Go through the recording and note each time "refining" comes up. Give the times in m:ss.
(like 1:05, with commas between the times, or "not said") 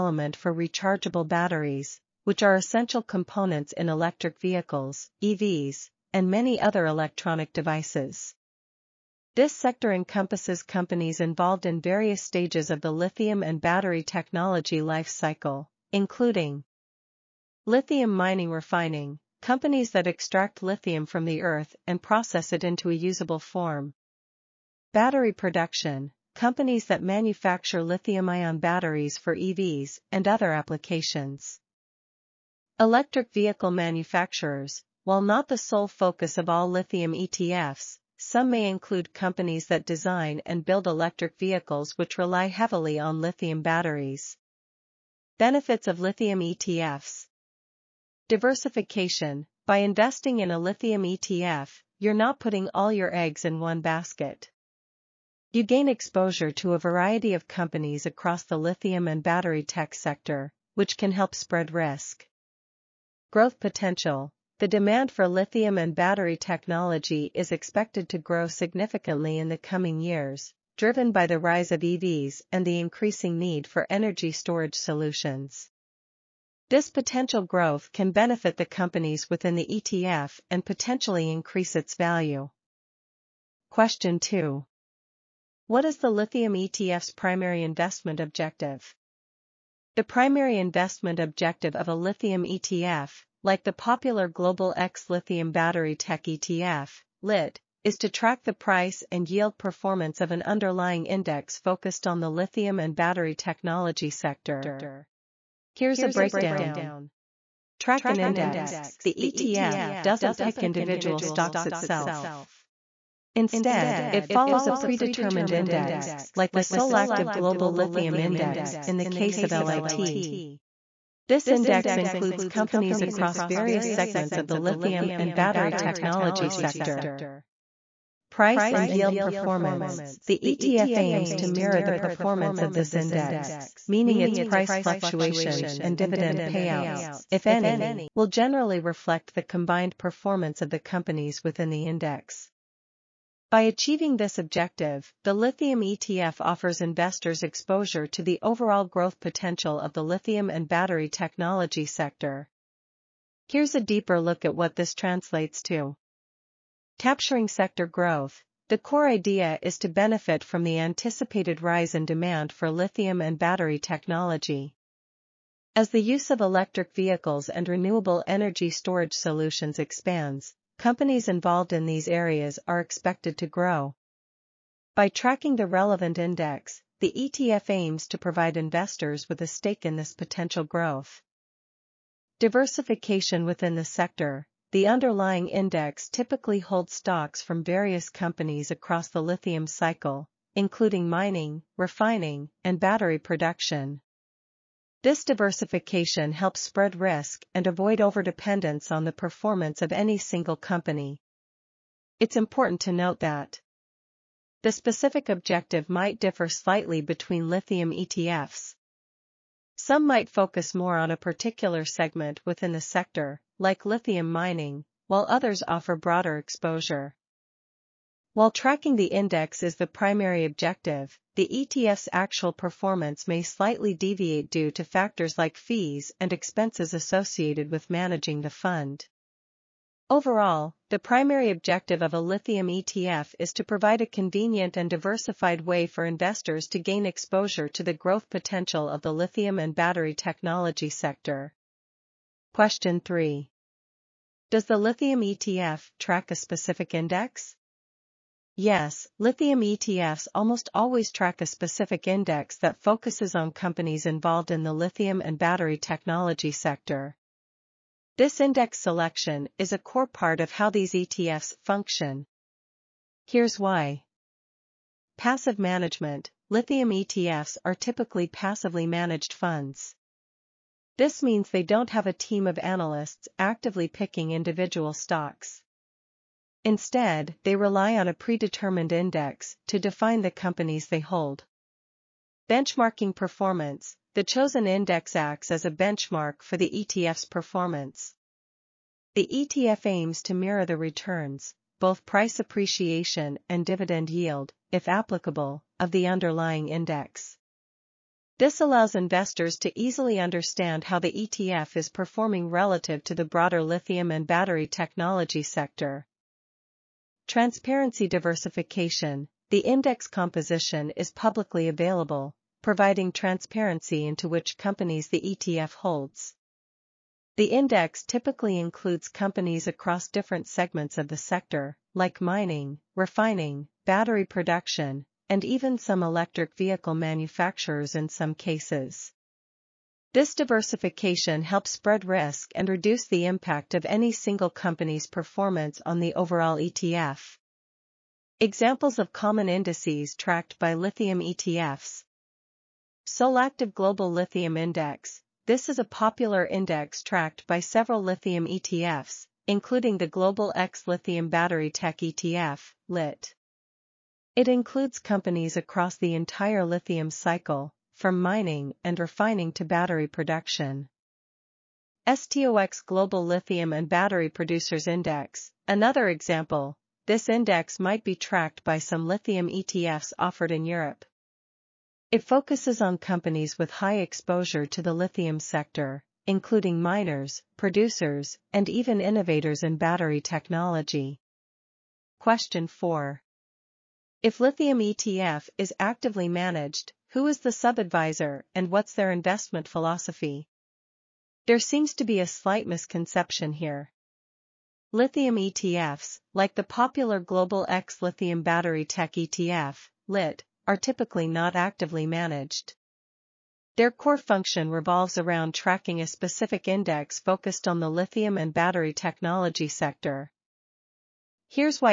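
0:18, 3:11, 5:22, 5:58.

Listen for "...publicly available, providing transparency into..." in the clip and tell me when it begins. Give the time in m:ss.
5:11.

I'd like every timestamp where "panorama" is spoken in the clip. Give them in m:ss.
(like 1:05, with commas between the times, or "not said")
not said.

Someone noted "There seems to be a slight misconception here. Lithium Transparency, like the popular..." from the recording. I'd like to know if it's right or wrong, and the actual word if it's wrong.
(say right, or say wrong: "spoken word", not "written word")
wrong: "ETFs", not "Transparency".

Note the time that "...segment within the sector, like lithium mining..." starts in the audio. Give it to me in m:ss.
3:31.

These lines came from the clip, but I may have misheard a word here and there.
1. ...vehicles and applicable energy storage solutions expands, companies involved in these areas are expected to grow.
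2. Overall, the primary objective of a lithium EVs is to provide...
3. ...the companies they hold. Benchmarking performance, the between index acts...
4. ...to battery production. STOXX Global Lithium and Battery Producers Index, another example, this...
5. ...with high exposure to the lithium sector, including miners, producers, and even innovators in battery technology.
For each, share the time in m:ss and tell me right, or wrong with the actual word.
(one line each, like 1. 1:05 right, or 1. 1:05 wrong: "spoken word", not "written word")
1. 2:46 wrong: "renewable", not "applicable"
2. 3:50 wrong: "ETF", not "EVs"
3. 4:40 wrong: "chosen", not "between"
4. 5:59 right
5. 6:13 right.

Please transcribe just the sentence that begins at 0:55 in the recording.
You gain exposure to a variety of companies across the lithium and battery tech sector, which can help spread risk.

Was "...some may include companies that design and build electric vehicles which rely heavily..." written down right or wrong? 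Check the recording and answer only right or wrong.
right.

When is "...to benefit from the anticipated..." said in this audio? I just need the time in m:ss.
2:39.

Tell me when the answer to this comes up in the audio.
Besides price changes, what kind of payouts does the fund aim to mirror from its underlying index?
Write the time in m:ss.
2:15.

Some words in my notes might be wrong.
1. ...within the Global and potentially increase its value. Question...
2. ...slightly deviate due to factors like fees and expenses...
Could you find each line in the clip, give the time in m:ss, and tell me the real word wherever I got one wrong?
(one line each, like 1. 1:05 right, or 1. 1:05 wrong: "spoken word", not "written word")
1. 1:19 wrong: "ETF", not "Global"
2. 3:43 right.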